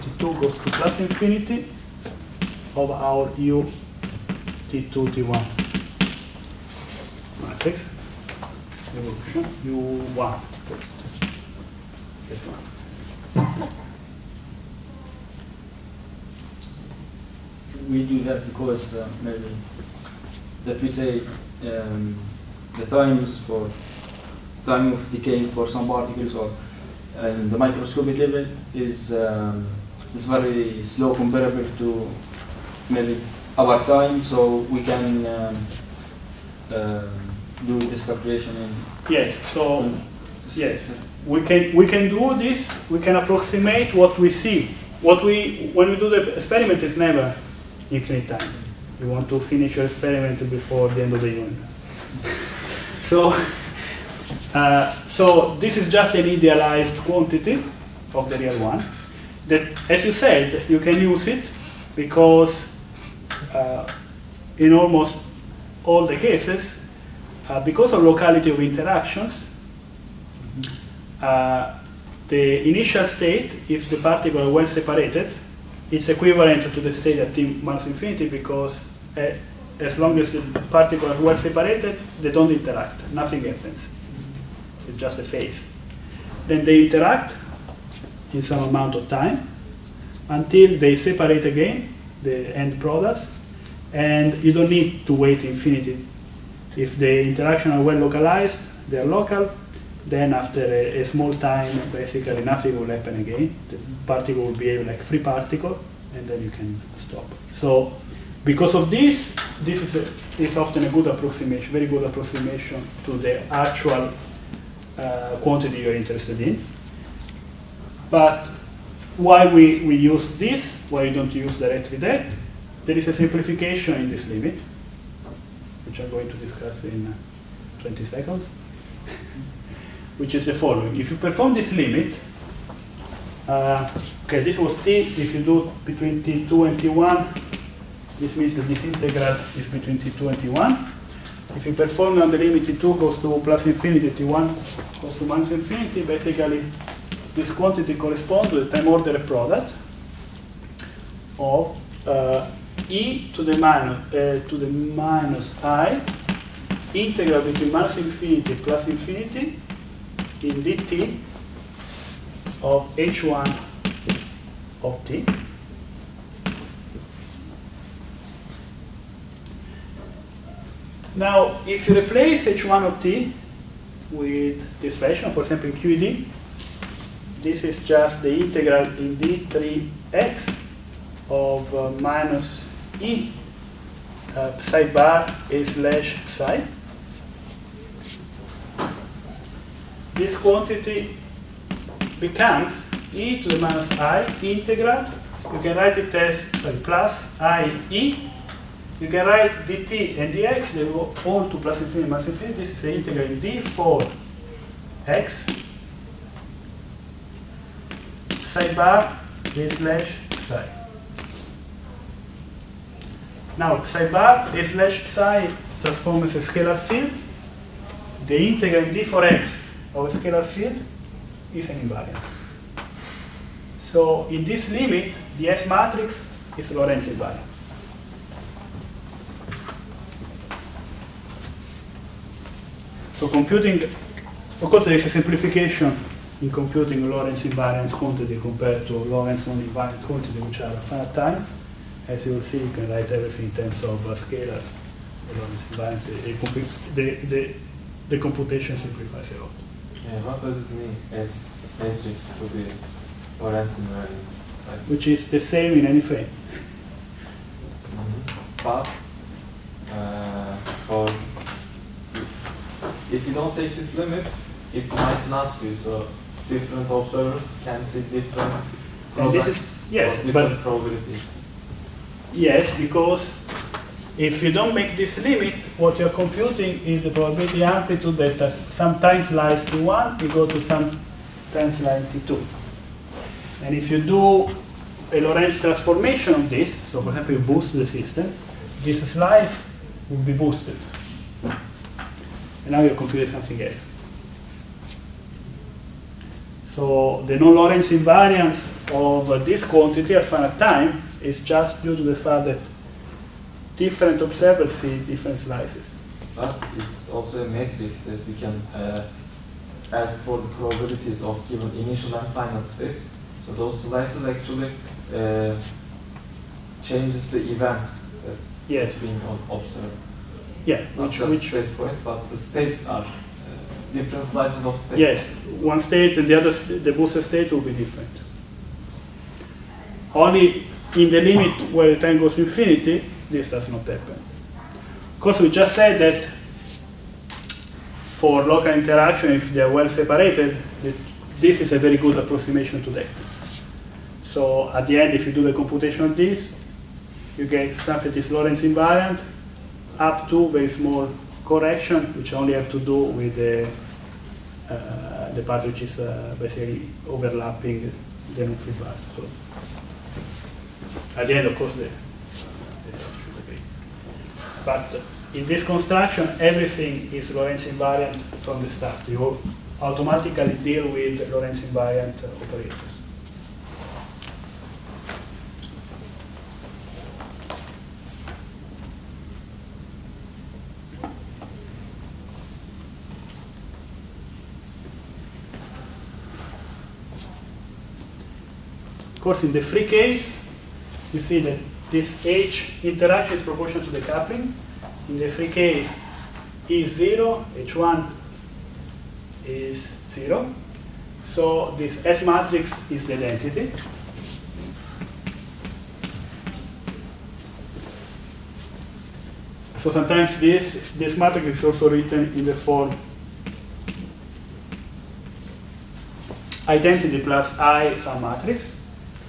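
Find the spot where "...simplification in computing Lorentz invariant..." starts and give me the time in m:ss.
3:55.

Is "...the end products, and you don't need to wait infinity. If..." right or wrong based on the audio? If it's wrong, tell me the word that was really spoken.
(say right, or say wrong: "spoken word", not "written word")
right.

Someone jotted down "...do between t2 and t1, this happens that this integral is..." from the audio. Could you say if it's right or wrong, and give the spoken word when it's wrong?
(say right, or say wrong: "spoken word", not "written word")
wrong: "means", not "happens".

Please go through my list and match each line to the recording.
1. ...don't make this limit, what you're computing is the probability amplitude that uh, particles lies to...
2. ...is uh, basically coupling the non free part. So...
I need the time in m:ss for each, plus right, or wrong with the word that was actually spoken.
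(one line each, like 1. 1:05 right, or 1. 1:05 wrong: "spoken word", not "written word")
1. 4:34 wrong: "sometimes", not "particles"
2. 5:55 wrong: "overlapping", not "coupling".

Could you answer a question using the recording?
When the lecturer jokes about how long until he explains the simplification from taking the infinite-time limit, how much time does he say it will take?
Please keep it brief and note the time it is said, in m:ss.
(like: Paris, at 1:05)
20 seconds, at 2:07.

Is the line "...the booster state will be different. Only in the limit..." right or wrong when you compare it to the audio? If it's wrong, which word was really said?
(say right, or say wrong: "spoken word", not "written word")
right.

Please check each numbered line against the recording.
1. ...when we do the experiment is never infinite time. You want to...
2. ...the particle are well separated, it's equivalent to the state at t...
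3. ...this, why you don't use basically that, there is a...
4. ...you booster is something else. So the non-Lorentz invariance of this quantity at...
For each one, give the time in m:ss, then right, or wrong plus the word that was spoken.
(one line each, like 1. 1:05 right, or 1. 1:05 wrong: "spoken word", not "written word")
1. 0:45 right
2. 1:13 right
3. 2:00 wrong: "directly", not "basically"
4. 4:52 wrong: "computer", not "booster".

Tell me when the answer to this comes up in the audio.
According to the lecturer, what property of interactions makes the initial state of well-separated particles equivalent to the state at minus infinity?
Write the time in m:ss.
1:08.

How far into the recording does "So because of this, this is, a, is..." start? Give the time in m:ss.
1:47.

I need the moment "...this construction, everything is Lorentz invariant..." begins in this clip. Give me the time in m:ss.
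6:05.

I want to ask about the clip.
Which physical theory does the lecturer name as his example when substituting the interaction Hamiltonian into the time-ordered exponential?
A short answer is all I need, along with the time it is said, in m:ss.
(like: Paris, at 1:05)
QED, at 2:55.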